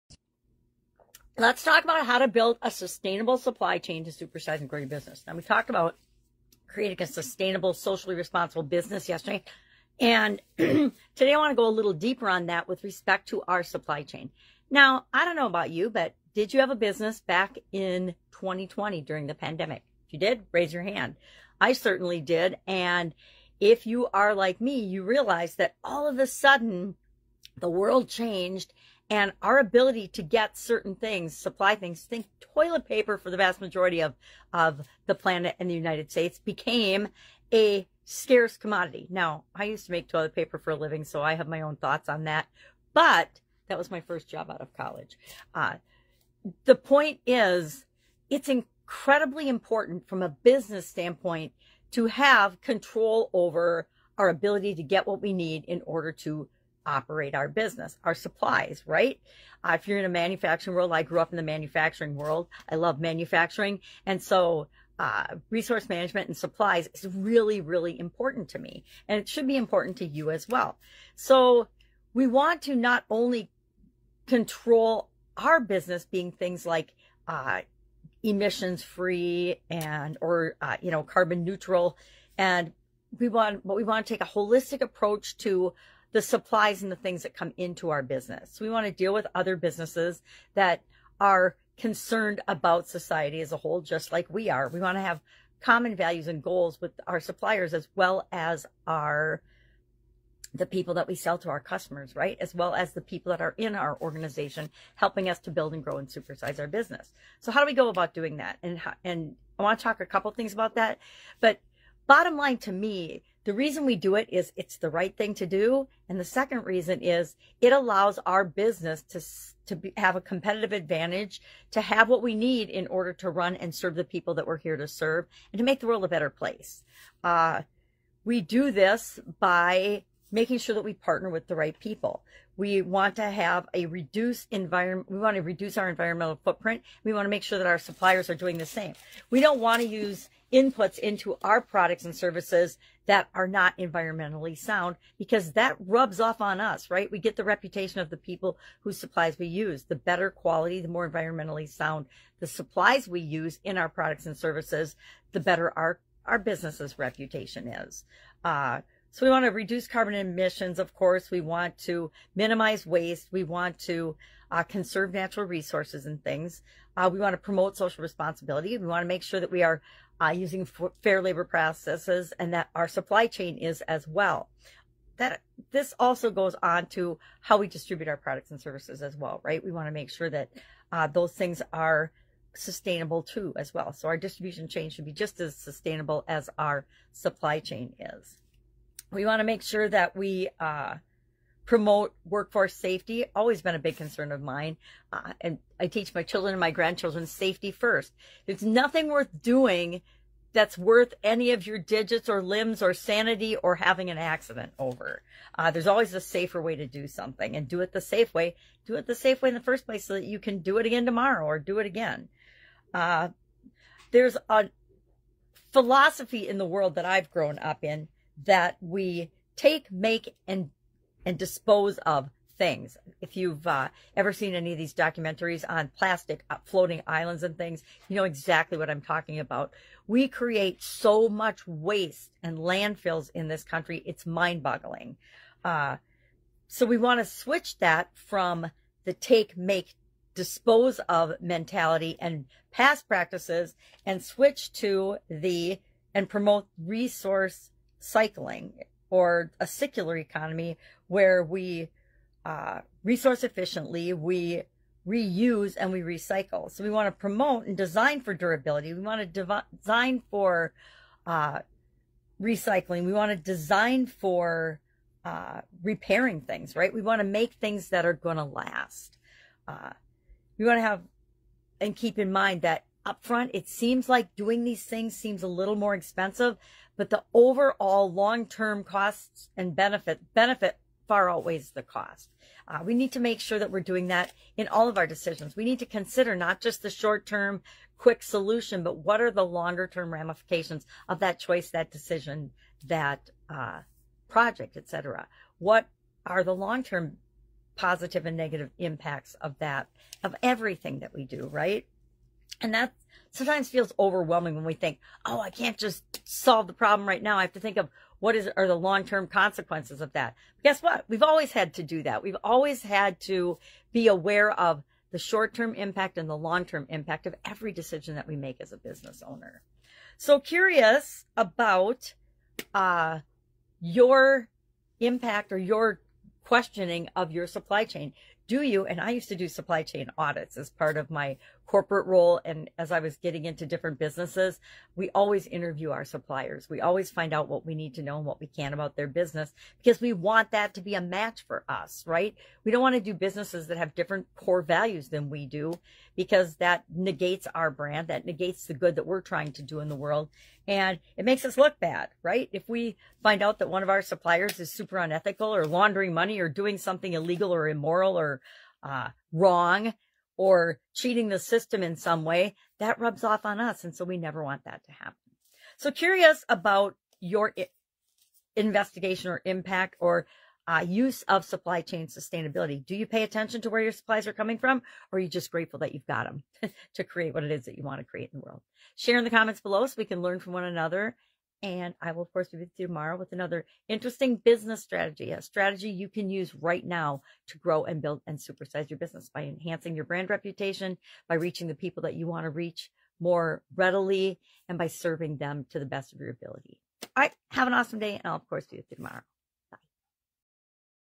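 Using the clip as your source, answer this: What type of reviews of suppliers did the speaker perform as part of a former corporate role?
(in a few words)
supply chain audits.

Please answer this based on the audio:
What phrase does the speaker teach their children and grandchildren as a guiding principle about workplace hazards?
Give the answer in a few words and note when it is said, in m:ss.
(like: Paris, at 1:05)
safety first, at 3:17.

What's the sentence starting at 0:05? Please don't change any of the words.
Now, we talked about creating a sustainable, socially responsible business yesterday.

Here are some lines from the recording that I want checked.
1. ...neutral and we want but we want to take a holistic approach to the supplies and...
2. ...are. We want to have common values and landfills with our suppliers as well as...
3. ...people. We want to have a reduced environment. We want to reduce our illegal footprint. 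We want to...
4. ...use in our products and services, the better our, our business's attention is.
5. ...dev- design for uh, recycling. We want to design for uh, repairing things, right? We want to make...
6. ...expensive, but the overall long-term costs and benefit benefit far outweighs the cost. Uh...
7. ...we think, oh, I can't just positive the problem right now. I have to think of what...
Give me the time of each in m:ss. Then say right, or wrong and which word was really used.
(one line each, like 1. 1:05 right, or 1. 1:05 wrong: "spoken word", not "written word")
1. 1:21 right
2. 1:34 wrong: "goals", not "landfills"
3. 2:11 wrong: "environmental", not "illegal"
4. 2:33 wrong: "reputation", not "attention"
5. 4:19 right
6. 4:35 right
7. 5:04 wrong: "solve", not "positive".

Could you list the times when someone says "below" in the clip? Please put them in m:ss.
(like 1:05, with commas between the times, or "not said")
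6:19.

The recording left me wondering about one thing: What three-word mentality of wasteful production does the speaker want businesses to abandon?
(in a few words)
take, make, dispose.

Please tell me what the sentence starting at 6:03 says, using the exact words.
And so we never want that to happen.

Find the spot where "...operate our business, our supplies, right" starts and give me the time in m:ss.
0:56.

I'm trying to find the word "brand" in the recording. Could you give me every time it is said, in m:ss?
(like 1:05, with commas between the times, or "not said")
5:47, 6:30.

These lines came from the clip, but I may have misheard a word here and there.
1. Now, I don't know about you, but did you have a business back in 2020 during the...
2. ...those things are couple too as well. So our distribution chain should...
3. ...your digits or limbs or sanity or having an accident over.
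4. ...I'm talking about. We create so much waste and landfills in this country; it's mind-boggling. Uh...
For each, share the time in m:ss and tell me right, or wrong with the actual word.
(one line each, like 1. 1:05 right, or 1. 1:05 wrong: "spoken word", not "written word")
1. 0:14 right
2. 3:01 wrong: "sustainable", not "couple"
3. 3:21 right
4. 3:48 right.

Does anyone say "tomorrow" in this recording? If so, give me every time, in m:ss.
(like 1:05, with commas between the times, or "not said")
3:31, 6:22, 6:38.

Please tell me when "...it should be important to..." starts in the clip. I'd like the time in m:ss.
1:09.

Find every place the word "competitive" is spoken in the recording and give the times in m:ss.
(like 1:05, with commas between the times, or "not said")
2:00.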